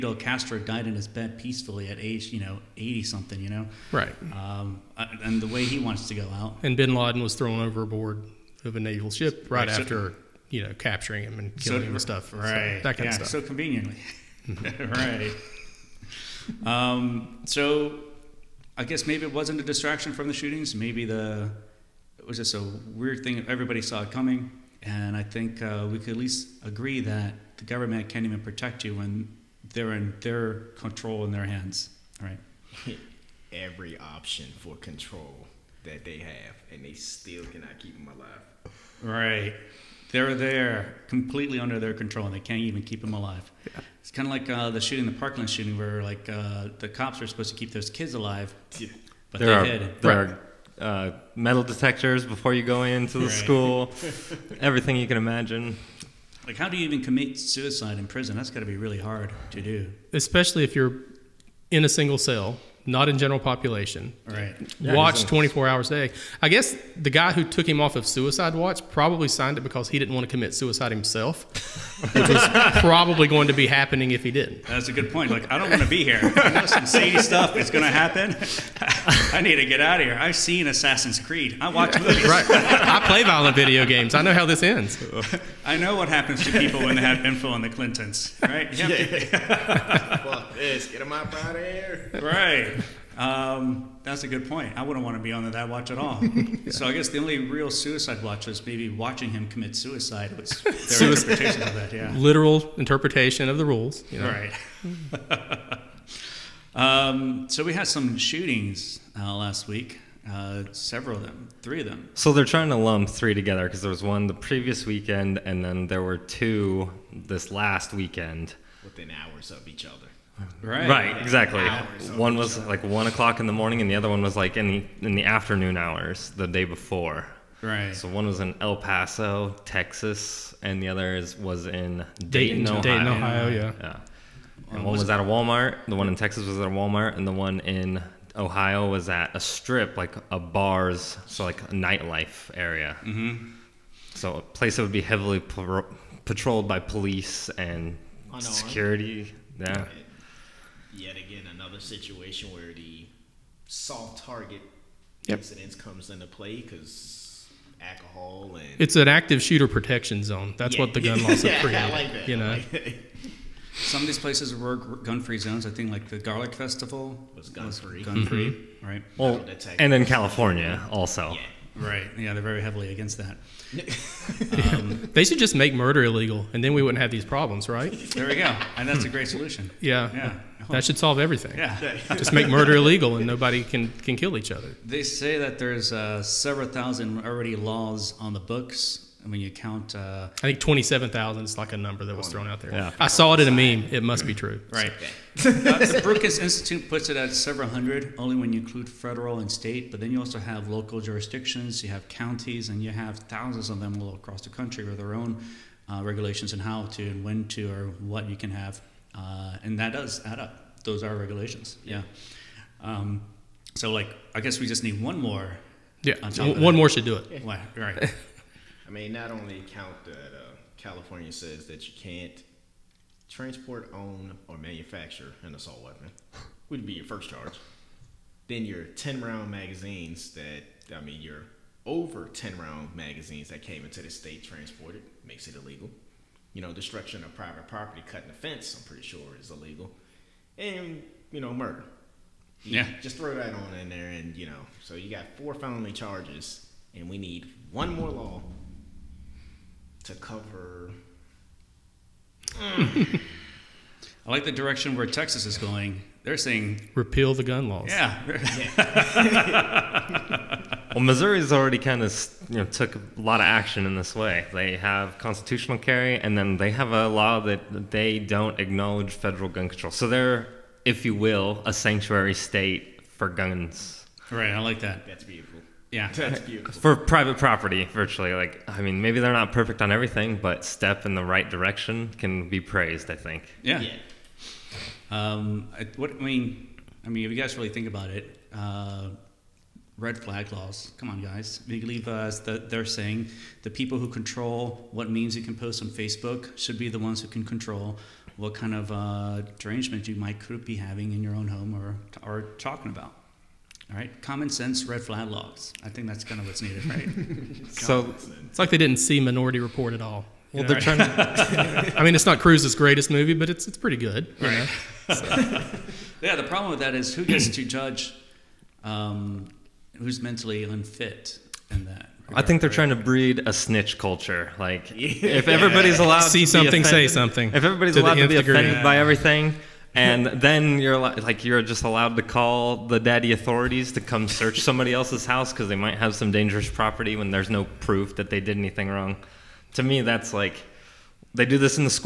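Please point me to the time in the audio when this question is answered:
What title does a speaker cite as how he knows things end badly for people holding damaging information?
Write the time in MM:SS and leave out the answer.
01:20.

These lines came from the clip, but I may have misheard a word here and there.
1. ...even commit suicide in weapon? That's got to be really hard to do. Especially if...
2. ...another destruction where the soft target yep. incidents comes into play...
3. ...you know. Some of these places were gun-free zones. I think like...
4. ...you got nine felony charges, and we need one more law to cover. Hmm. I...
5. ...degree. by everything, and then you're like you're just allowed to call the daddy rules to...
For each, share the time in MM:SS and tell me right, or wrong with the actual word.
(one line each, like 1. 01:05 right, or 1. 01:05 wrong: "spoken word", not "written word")
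1. 00:56 wrong: "prison", not "weapon"
2. 02:31 wrong: "situation", not "destruction"
3. 02:42 right
4. 04:04 wrong: "four", not "nine"
5. 05:28 wrong: "authorities", not "rules".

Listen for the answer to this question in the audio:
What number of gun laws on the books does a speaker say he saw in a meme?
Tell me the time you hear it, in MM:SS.
03:10.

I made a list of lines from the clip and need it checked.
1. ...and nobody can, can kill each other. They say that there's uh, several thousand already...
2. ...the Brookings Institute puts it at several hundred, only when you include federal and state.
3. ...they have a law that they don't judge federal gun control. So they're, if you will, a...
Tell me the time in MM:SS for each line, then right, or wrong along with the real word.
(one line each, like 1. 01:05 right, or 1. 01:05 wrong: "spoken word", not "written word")
1. 03:03 right
2. 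03:15 right
3. 04:26 wrong: "acknowledge", not "judge".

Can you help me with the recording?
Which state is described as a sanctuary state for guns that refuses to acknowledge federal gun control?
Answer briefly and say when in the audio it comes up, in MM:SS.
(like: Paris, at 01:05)
Missouri, at 04:21.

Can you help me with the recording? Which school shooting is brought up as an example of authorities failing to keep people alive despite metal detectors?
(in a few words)
Parkland.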